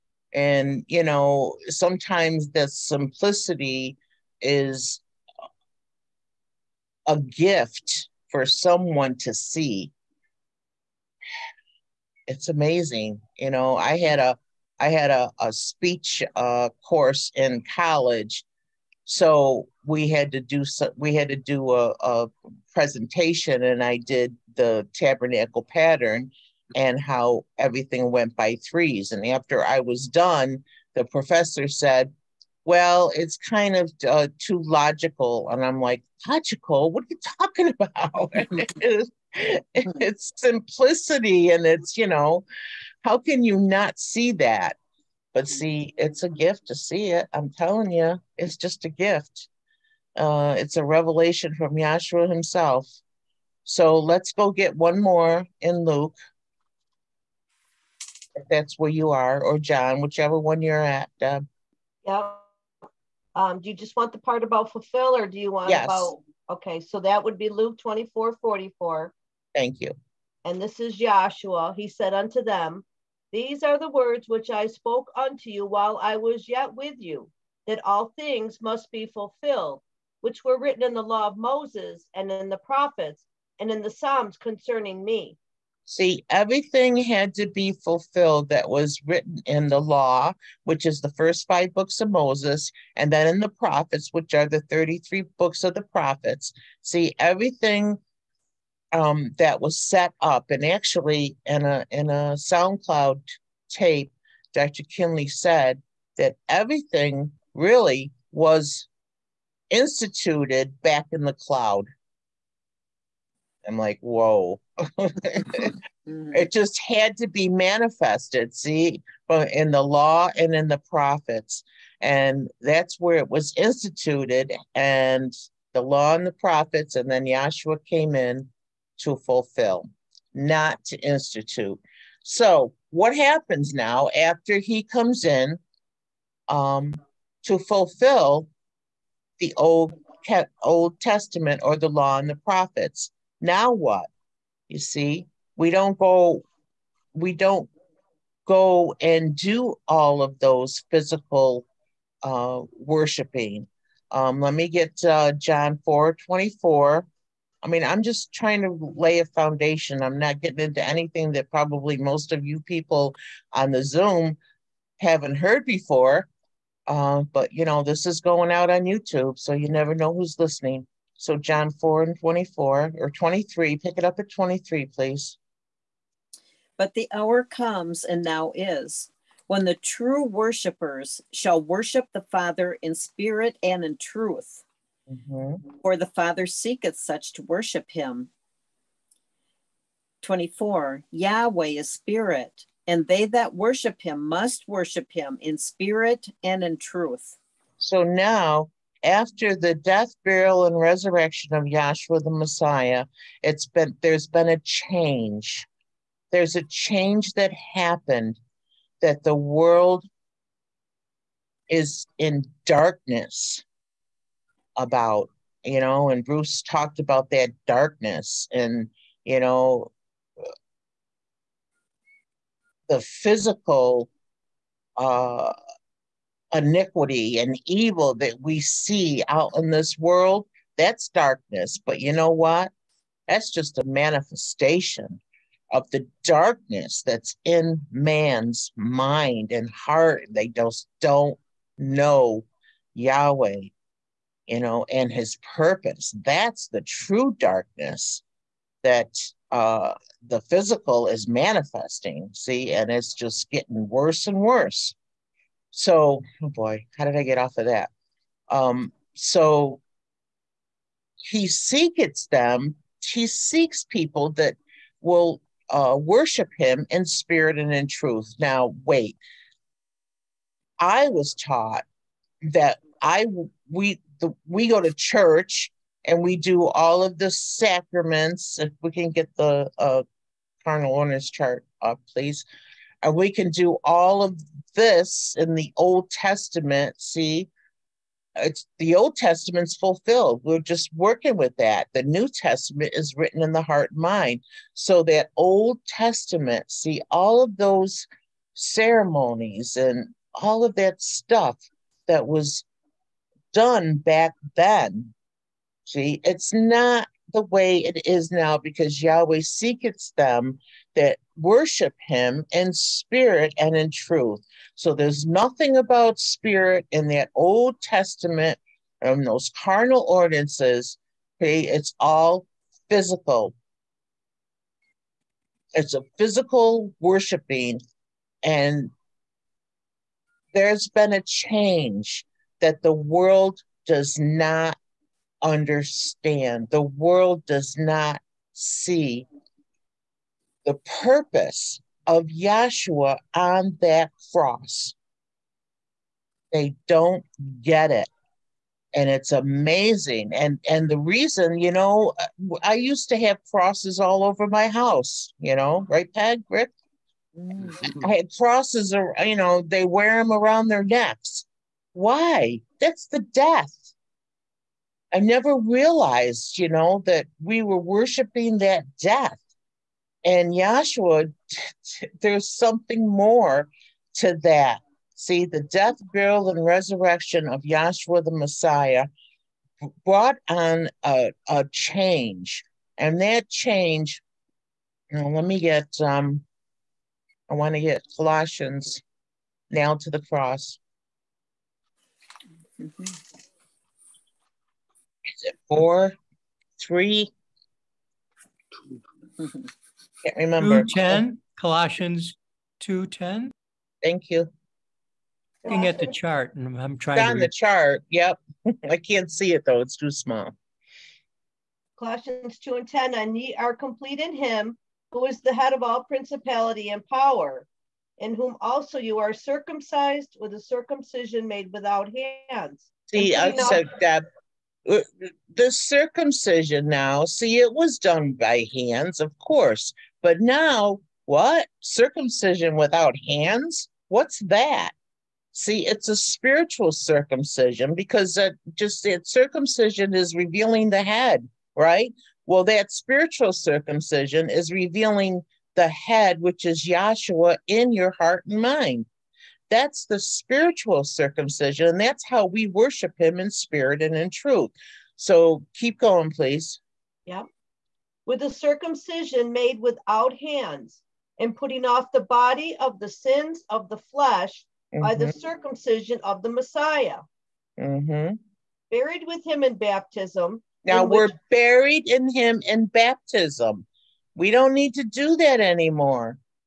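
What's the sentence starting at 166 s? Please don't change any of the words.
Uh, but, you know, this is going out on YouTube, so you never know who's listening.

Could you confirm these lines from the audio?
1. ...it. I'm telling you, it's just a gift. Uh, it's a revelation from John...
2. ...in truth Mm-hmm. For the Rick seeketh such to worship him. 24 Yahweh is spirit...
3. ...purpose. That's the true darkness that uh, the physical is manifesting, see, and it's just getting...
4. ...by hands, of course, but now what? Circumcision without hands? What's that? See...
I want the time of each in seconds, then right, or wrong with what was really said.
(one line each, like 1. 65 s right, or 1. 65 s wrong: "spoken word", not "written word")
1. 47 s wrong: "Yahshua", not "John"
2. 183 s wrong: "Father", not "Rick"
3. 245 s right
4. 428 s right.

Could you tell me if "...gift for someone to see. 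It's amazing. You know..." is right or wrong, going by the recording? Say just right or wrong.
right.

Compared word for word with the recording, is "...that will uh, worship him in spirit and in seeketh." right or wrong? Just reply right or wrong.
wrong.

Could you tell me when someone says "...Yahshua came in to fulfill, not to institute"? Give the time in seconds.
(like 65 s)
127 s.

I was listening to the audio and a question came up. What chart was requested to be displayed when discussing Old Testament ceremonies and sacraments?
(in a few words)
carnal ordinances chart.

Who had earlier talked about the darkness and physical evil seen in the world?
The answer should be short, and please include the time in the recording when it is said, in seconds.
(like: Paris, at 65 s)
Bruce, at 216 s.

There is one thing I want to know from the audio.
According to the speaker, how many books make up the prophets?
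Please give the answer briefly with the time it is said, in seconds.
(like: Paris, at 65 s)
33, at 94 s.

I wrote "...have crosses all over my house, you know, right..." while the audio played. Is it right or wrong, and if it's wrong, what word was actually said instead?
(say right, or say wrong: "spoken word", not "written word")
right.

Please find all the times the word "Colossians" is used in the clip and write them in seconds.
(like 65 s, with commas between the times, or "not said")
388 s, 401 s, 411 s.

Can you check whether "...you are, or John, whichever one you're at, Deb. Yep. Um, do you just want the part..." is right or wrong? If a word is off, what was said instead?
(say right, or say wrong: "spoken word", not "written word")
right.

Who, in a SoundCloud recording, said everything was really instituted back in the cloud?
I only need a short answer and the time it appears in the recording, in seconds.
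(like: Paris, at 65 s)
Dr. Kinley, at 104 s.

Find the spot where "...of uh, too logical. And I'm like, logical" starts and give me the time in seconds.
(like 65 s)
33 s.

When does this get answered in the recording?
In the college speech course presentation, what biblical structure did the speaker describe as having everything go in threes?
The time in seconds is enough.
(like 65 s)
24 s.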